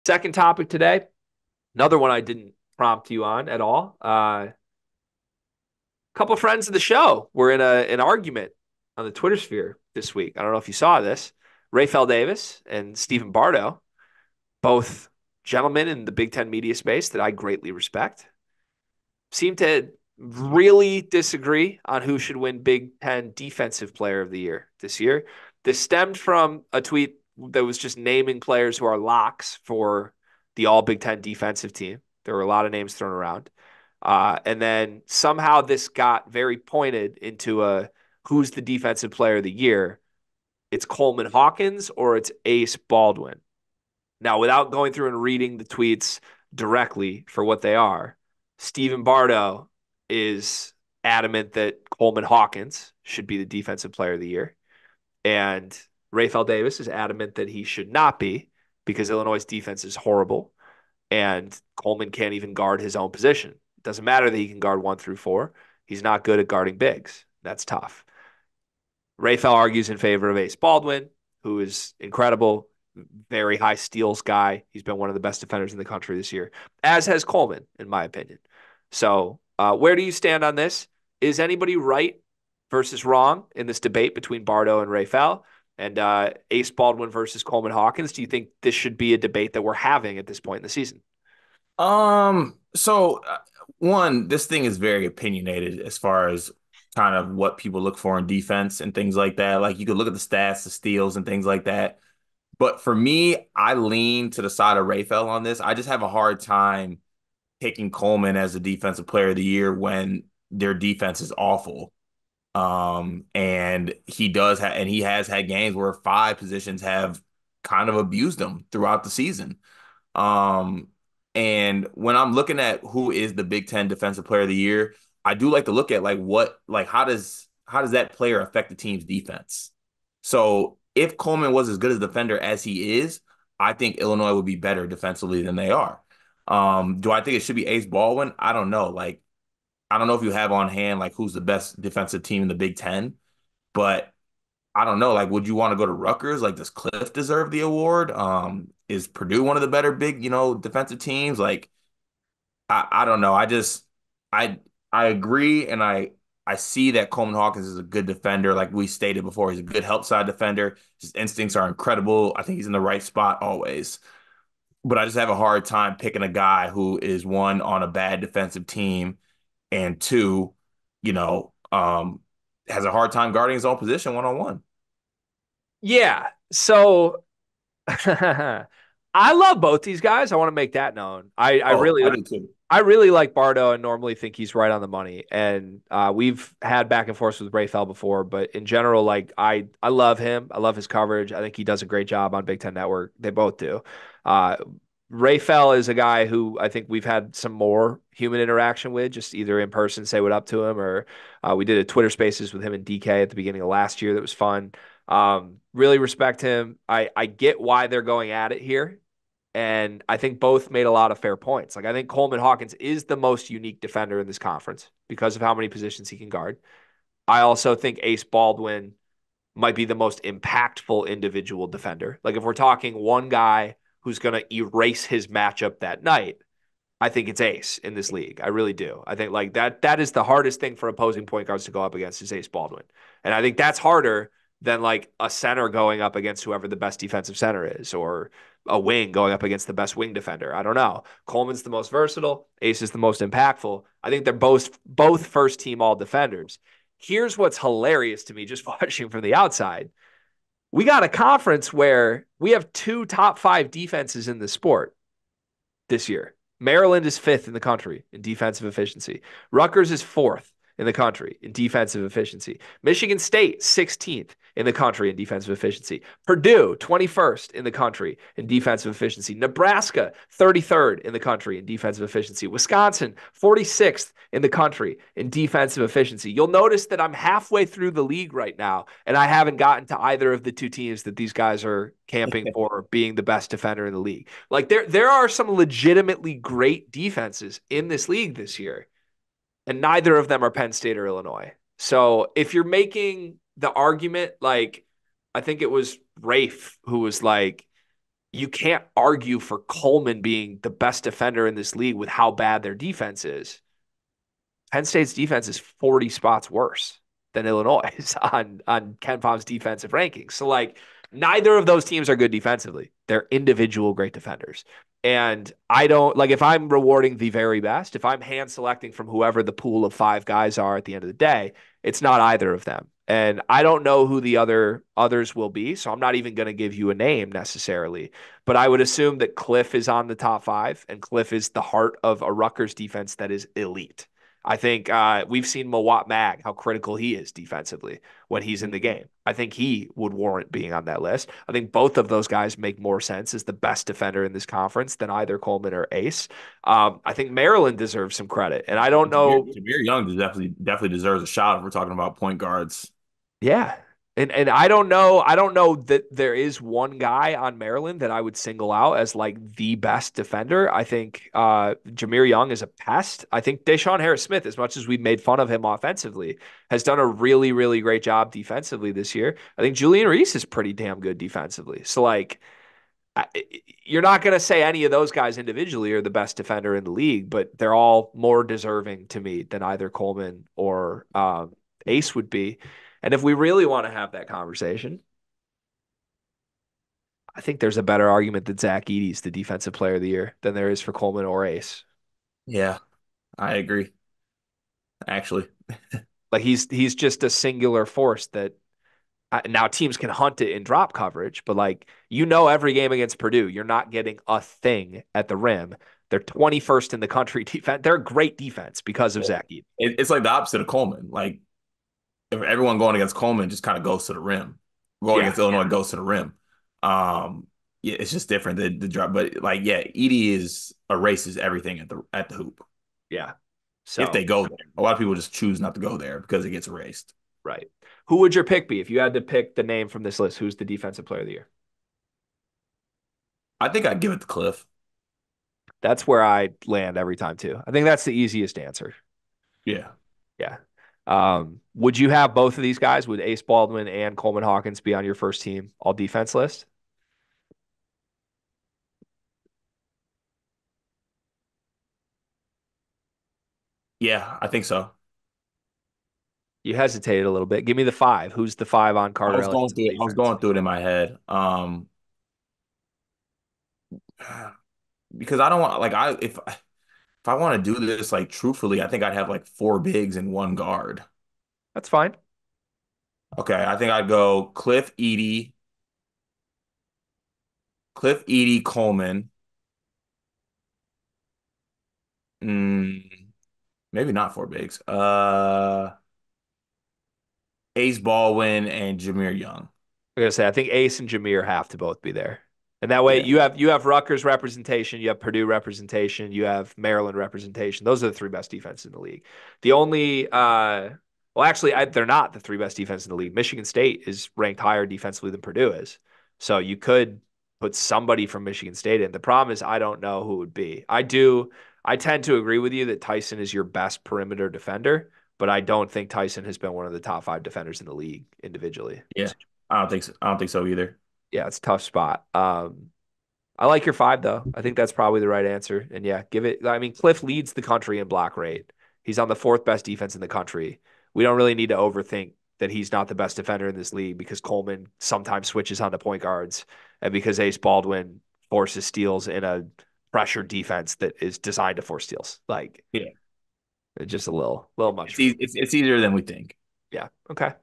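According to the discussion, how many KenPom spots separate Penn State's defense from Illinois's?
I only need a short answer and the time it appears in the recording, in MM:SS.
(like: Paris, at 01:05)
40, at 05:05.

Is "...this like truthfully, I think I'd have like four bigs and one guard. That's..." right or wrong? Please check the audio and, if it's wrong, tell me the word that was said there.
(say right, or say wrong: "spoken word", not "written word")
right.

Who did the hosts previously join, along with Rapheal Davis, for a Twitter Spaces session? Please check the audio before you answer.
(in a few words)
DK.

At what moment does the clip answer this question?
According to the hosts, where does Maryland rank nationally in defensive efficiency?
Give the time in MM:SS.
04:17.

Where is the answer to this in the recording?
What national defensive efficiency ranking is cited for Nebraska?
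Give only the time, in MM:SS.
04:30.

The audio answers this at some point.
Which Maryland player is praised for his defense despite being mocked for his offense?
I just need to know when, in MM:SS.
06:03.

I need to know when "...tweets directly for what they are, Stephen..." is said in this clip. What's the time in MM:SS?
00:45.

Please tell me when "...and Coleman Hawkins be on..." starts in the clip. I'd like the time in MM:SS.
07:23.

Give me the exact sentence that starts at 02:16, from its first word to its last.
Um, do I think it should be Ace Baldwin?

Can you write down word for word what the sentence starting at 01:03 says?
It doesn't matter that he can guard one through four.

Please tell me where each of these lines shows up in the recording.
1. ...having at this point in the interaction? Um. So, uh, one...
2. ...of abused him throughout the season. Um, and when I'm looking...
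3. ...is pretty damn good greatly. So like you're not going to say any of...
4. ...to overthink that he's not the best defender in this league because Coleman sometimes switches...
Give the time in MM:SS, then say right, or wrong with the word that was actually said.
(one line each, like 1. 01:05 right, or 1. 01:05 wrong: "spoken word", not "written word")
1. 01:29 wrong: "season", not "interaction"
2. 01:57 right
3. 06:10 wrong: "defensively", not "greatly"
4. 08:51 right.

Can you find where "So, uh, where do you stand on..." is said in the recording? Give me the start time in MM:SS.
01:18.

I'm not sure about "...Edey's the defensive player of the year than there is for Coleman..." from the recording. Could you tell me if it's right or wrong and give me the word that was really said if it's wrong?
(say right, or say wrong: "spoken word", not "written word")
right.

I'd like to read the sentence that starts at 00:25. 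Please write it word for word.
This stemmed from a tweet that was just naming players who are locks for the all Big Ten defensive team.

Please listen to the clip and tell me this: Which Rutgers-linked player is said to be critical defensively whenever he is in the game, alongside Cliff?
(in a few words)
Mawot Mag.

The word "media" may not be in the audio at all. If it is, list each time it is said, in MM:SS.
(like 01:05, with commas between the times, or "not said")
00:16.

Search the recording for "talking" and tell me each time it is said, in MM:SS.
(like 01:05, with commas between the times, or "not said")
03:42, 05:51.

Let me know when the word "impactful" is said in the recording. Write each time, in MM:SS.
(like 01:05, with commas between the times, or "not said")
03:40, 04:03.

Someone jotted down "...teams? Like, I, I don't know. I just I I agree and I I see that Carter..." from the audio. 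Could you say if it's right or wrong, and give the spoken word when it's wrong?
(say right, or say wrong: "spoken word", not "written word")
wrong: "Coleman", not "Carter".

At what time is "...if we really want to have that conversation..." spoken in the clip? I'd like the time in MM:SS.
06:23.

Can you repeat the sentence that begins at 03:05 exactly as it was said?
And uh, we've had back and forth with Fell before, but in general, like I I love him.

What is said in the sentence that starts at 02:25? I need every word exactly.
Like, would you want to go to Rutgers?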